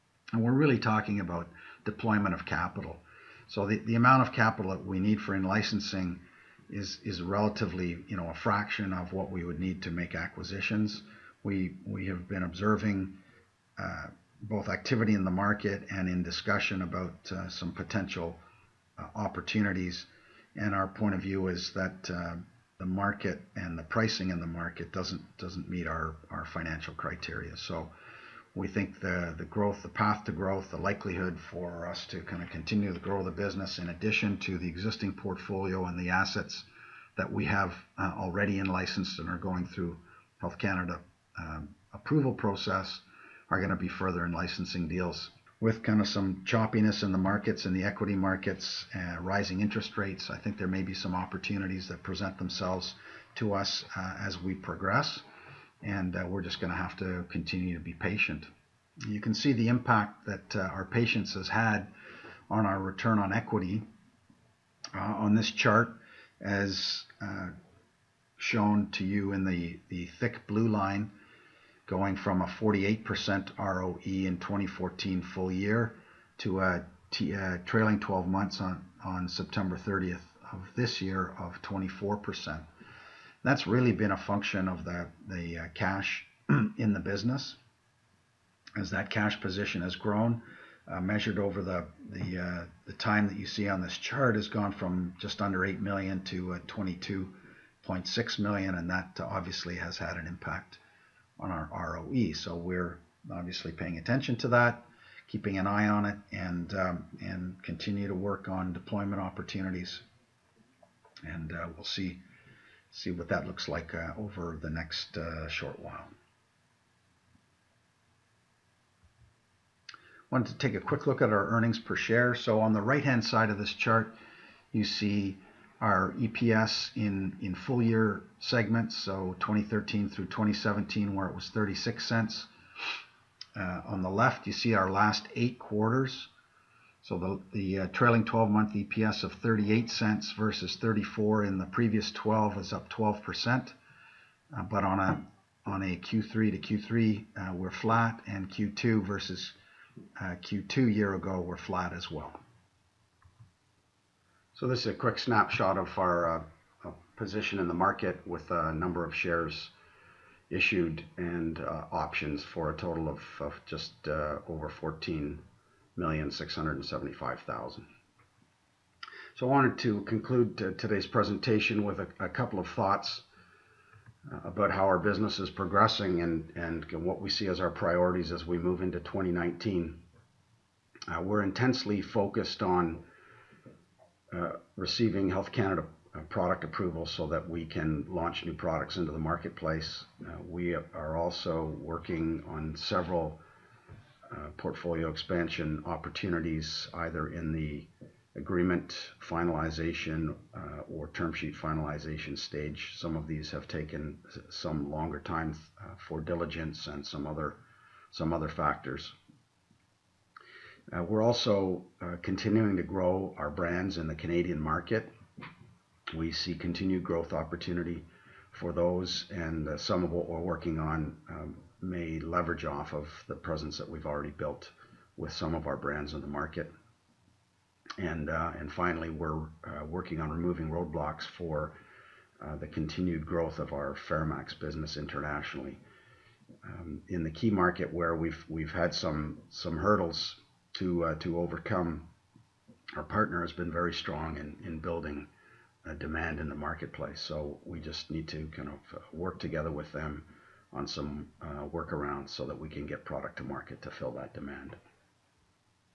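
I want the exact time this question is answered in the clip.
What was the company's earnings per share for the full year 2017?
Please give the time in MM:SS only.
02:11.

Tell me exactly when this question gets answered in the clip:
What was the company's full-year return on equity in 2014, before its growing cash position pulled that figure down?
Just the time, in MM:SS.
01:12.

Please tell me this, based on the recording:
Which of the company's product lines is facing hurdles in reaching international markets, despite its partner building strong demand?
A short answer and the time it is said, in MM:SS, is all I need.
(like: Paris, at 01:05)
FeraMAX, at 03:54.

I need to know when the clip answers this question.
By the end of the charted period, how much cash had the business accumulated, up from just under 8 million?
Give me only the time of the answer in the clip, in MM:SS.
01:36.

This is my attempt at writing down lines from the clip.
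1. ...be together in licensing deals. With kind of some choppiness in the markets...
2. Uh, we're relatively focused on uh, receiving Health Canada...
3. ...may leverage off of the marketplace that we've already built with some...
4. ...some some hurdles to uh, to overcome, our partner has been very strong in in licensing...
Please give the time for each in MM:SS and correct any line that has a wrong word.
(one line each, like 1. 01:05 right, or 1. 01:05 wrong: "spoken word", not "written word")
1. 00:43 wrong: "further", not "together"
2. 03:01 wrong: "intensely", not "relatively"
3. 03:41 wrong: "presence", not "marketplace"
4. 03:58 wrong: "building", not "licensing".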